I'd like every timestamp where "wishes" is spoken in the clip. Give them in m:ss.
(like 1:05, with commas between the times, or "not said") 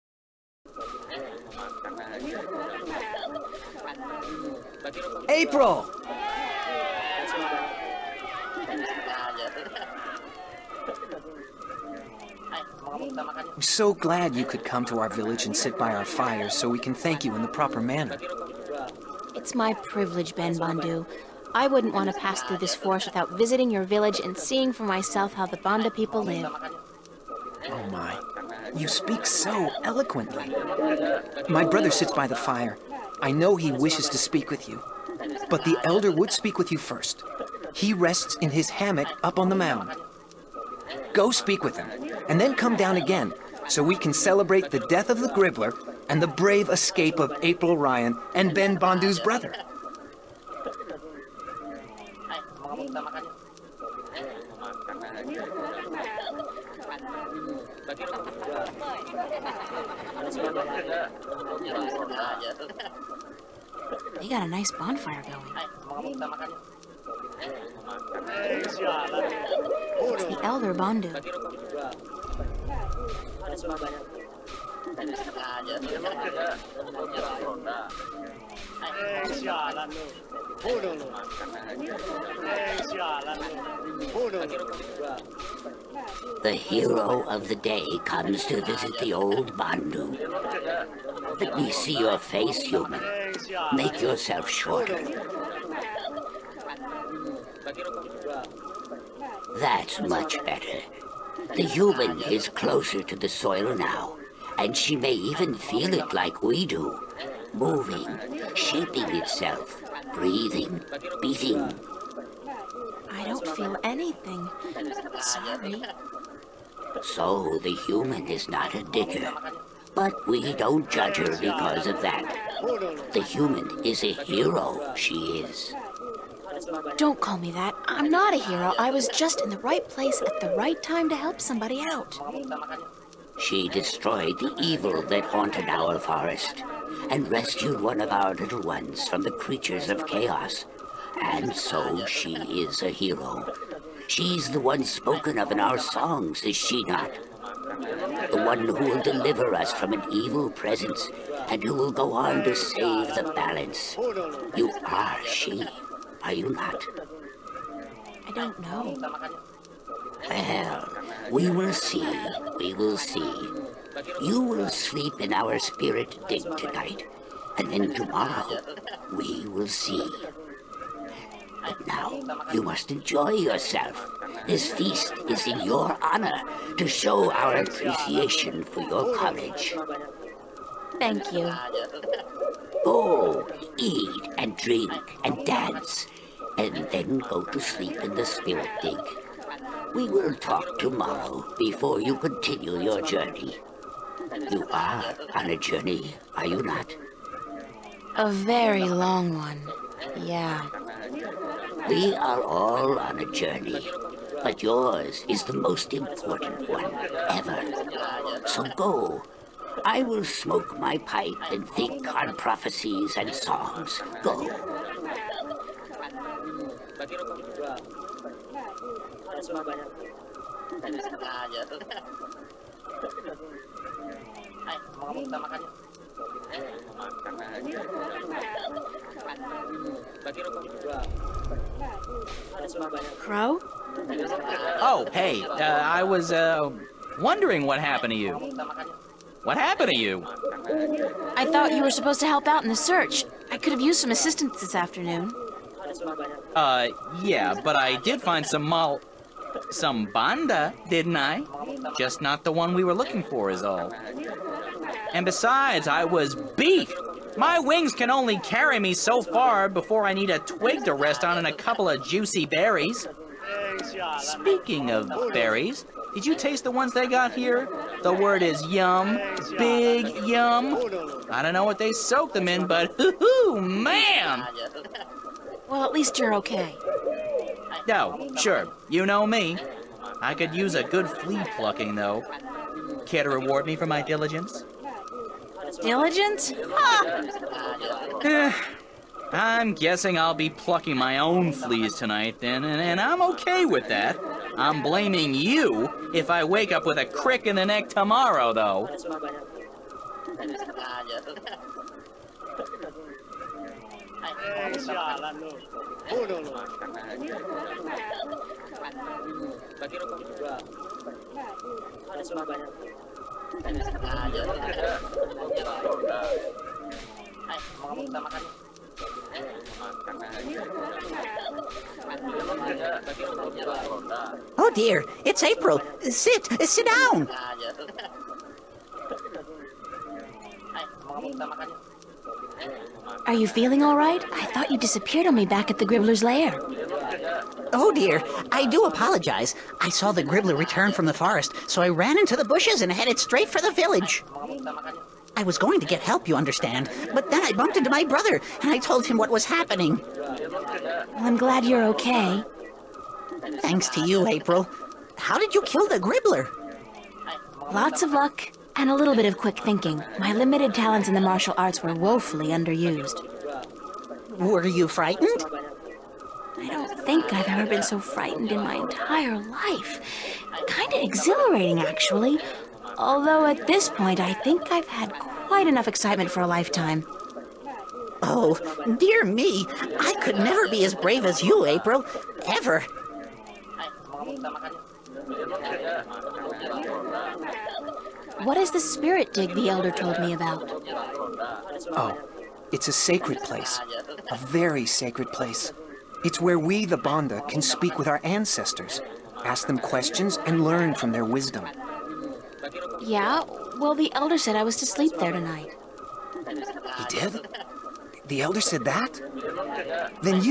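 0:33.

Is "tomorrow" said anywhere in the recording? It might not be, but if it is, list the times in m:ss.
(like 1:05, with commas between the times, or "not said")
2:47, 3:10, 4:57.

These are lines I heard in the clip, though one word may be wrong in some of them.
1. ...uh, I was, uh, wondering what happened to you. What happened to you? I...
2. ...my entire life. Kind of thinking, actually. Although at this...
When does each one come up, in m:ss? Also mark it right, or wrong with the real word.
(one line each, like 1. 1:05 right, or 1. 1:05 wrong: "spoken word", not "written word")
1. 3:55 right
2. 6:08 wrong: "exhilarating", not "thinking".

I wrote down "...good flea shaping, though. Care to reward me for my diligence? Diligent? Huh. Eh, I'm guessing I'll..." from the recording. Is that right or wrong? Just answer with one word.
wrong.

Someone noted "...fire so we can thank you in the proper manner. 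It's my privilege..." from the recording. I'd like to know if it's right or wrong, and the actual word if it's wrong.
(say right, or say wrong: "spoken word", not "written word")
right.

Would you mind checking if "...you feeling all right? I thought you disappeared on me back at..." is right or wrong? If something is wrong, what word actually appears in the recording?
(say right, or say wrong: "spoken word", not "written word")
right.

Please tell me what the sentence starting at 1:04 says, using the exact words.
They got a nice bonfire going.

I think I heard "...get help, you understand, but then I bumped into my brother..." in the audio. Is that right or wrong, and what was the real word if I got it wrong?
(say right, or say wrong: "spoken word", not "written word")
right.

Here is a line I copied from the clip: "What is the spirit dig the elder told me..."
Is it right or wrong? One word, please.
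right.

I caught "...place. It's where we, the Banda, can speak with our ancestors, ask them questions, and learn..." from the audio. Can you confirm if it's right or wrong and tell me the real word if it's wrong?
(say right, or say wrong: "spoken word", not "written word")
right.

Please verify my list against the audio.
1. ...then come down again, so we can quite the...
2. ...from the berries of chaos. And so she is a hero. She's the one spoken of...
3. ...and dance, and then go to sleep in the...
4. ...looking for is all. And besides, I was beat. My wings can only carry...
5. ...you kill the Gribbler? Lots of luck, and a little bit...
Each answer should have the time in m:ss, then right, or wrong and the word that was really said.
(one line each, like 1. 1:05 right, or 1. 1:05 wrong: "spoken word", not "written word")
1. 0:42 wrong: "celebrate", not "quite"
2. 2:19 wrong: "creatures", not "berries"
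3. 3:05 right
4. 4:12 right
5. 5:55 right.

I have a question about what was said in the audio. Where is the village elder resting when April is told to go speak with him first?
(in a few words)
In his hammock.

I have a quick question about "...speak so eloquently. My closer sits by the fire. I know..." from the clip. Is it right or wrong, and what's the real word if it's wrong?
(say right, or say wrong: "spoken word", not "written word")
wrong: "brother", not "closer".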